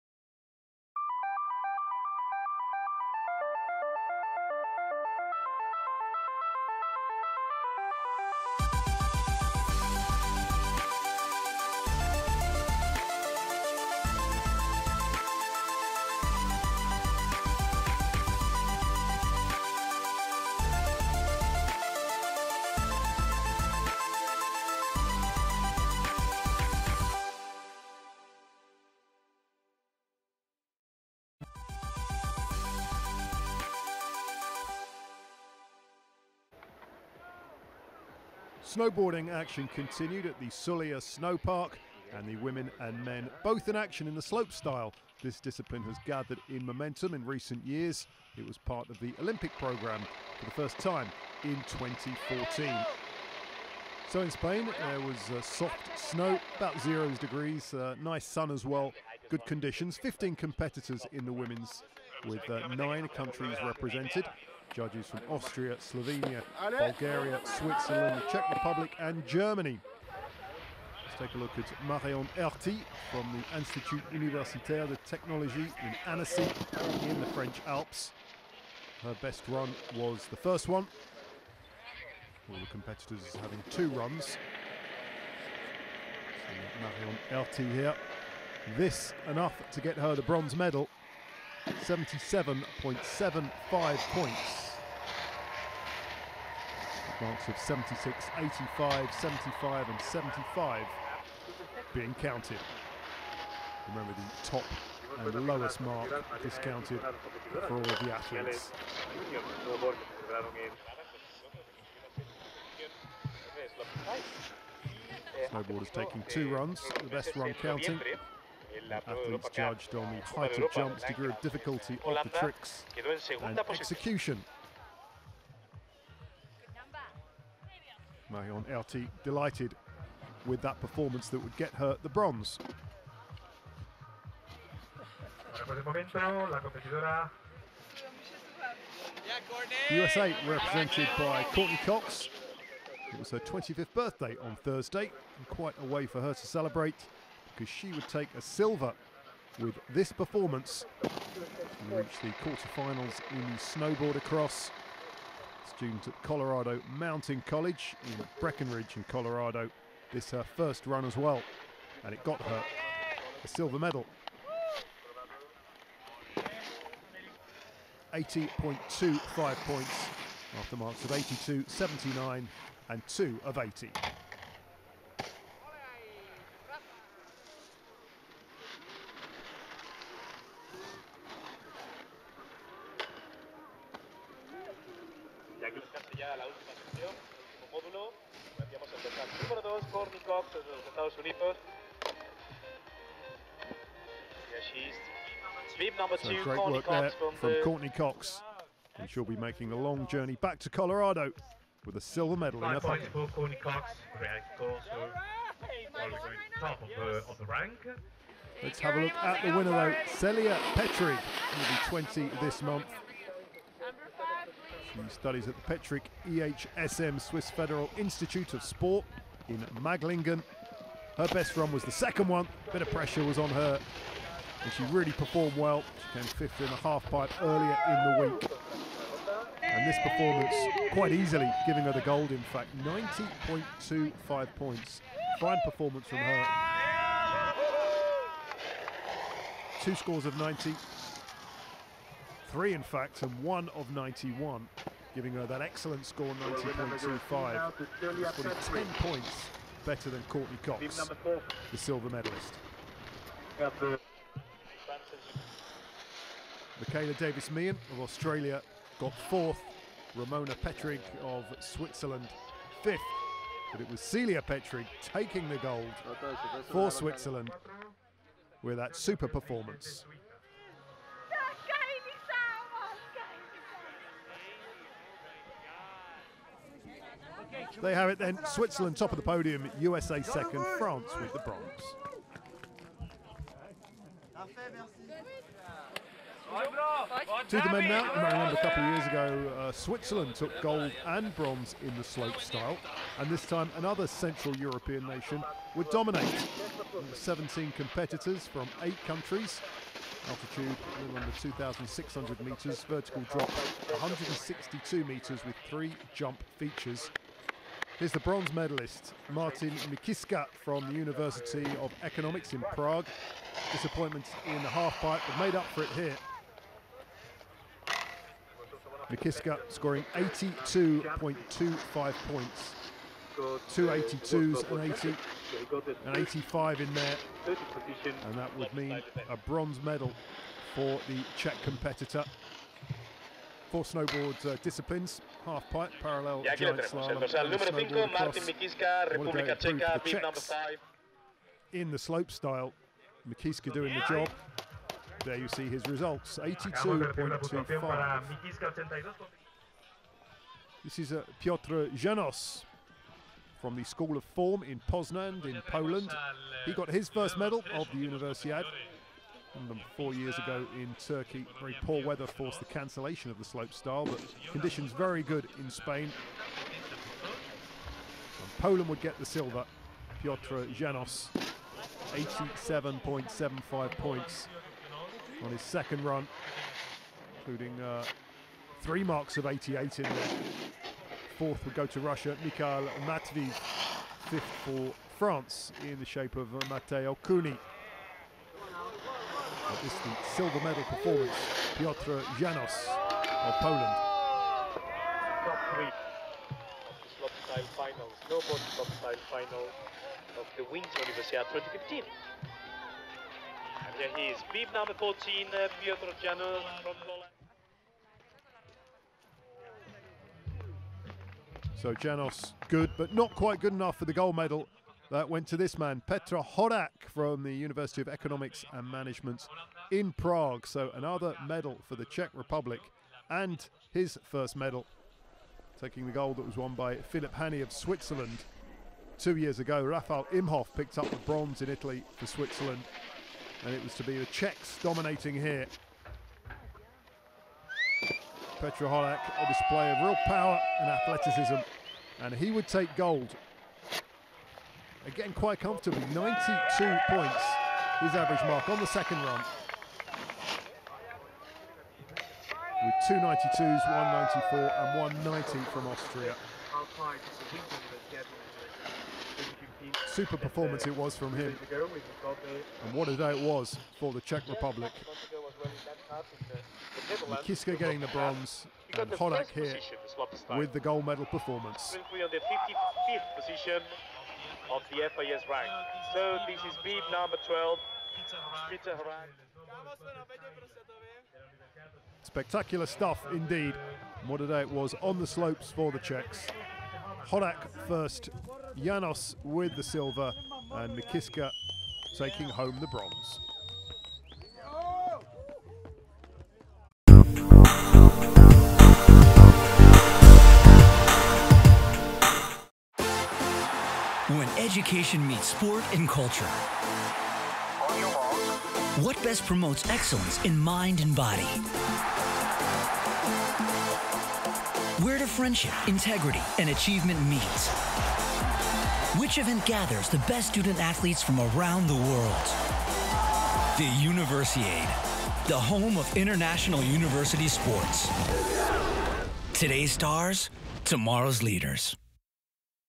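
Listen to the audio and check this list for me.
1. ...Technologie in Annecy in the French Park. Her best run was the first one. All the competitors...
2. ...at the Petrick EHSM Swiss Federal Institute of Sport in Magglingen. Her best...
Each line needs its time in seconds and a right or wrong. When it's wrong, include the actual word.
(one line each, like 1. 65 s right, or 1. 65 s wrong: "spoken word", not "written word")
1. 75 s wrong: "Alps", not "Park"
2. 215 s right.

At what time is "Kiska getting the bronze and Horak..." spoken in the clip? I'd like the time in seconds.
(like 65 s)
467 s.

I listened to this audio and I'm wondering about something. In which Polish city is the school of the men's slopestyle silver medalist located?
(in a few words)
Poznan.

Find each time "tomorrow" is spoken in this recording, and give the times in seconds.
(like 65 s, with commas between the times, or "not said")
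530 s.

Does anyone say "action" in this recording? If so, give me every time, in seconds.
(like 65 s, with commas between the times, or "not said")
39 s, 43 s.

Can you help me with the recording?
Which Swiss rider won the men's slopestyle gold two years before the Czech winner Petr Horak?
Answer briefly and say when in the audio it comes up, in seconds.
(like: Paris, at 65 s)
Philip Hanny, at 426 s.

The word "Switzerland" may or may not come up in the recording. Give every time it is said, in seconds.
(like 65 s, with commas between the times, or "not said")
67 s, 261 s, 266 s, 278 s, 289 s, 427 s, 432 s.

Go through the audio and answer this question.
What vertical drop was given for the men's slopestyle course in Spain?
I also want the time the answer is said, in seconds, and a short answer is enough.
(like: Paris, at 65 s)
162 metres, at 303 s.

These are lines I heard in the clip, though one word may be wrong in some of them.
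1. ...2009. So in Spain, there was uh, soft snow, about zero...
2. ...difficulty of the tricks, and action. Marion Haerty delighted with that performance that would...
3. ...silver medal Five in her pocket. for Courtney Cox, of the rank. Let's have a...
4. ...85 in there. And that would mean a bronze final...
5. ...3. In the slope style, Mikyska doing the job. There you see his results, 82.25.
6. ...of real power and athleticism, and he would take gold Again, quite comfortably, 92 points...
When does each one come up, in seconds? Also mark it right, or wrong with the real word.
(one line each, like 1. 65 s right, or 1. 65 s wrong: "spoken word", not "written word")
1. 51 s wrong: "2014", not "2009"
2. 121 s wrong: "execution", not "action"
3. 202 s right
4. 326 s wrong: "medal", not "final"
5. 340 s wrong: "5", not "3"
6. 439 s right.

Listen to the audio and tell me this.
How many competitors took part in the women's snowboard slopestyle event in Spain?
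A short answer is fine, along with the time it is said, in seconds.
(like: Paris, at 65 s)
15, at 59 s.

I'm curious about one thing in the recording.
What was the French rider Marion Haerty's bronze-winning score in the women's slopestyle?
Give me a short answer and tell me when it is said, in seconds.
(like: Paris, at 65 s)
77.75, at 91 s.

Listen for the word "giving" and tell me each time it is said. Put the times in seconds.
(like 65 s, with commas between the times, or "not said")
231 s, 245 s.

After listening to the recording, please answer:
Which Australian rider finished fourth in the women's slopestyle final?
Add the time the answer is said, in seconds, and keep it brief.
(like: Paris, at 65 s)
Michaela Davis-Meehan, at 256 s.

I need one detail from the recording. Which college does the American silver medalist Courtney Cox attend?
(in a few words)
Colorado Mountain College.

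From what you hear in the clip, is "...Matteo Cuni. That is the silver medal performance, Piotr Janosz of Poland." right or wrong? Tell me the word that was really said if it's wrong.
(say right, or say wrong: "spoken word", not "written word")
right.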